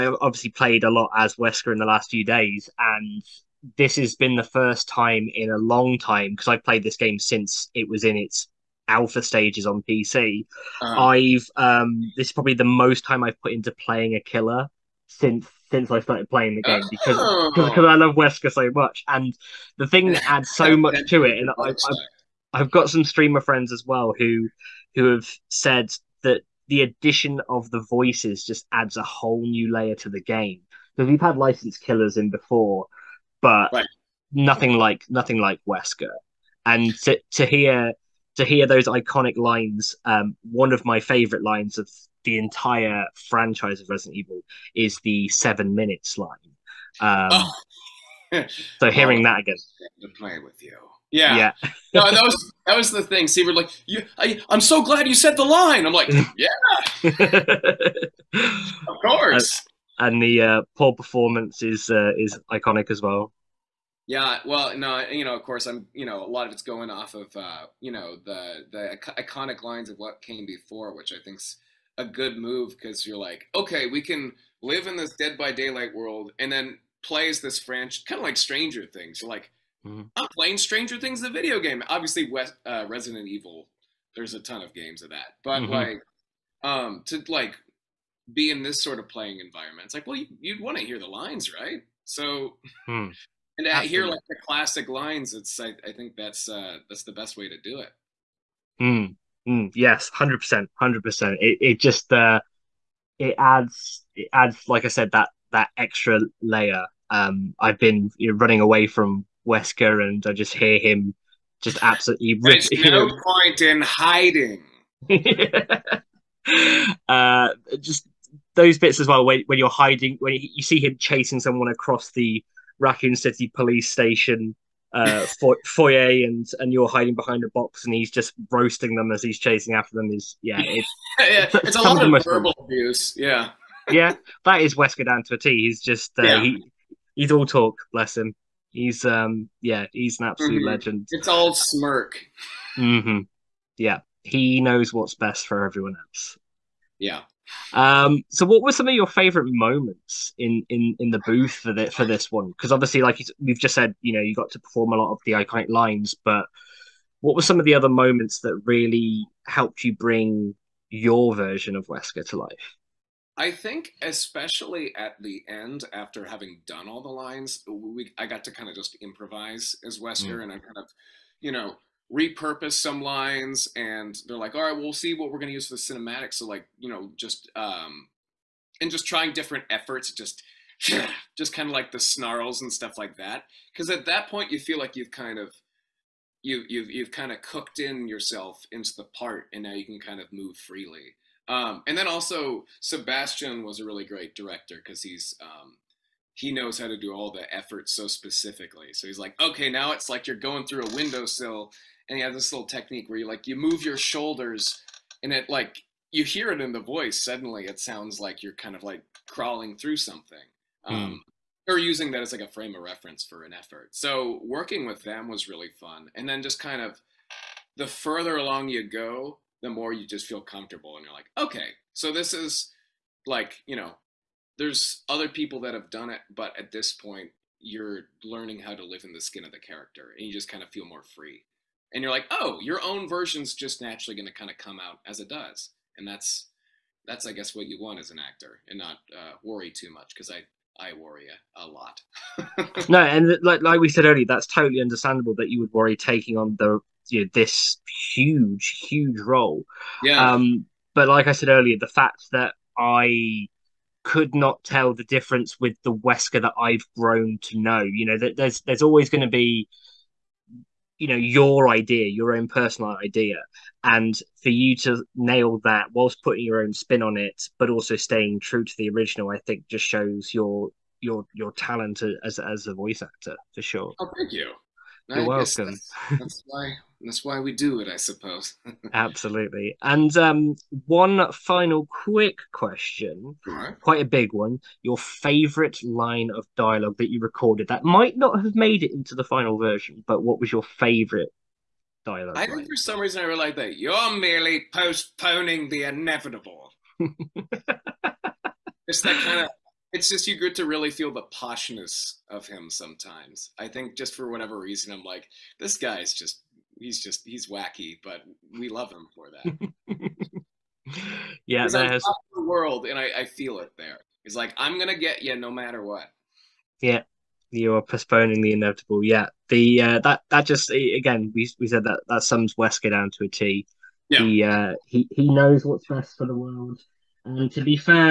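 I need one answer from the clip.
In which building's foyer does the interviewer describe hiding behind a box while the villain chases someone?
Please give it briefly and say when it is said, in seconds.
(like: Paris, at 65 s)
Raccoon City police station, at 122 s.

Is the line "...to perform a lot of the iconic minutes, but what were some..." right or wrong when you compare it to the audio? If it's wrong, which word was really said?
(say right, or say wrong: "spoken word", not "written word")
wrong: "lines", not "minutes".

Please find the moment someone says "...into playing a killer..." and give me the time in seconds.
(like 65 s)
13 s.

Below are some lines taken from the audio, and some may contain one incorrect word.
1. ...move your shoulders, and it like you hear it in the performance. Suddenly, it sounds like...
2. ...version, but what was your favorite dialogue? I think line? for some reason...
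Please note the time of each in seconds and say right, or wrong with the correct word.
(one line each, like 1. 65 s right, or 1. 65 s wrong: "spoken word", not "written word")
1. 203 s wrong: "voice", not "performance"
2. 289 s right.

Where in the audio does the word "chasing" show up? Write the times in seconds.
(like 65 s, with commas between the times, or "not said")
120 s, 129 s.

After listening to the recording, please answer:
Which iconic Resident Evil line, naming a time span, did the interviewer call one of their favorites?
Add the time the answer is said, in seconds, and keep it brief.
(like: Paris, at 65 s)
seven minutes, at 45 s.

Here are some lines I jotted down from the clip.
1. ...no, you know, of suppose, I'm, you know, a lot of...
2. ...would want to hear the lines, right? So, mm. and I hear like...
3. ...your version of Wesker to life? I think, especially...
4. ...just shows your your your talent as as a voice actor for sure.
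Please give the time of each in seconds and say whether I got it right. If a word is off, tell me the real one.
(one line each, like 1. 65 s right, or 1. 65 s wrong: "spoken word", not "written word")
1. 64 s wrong: "course", not "suppose"
2. 90 s right
3. 160 s right
4. 269 s right.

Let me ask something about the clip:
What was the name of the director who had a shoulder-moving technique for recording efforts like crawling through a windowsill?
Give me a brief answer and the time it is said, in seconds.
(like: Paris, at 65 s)
Sebastian, at 192 s.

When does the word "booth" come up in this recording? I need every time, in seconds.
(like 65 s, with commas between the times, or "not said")
151 s.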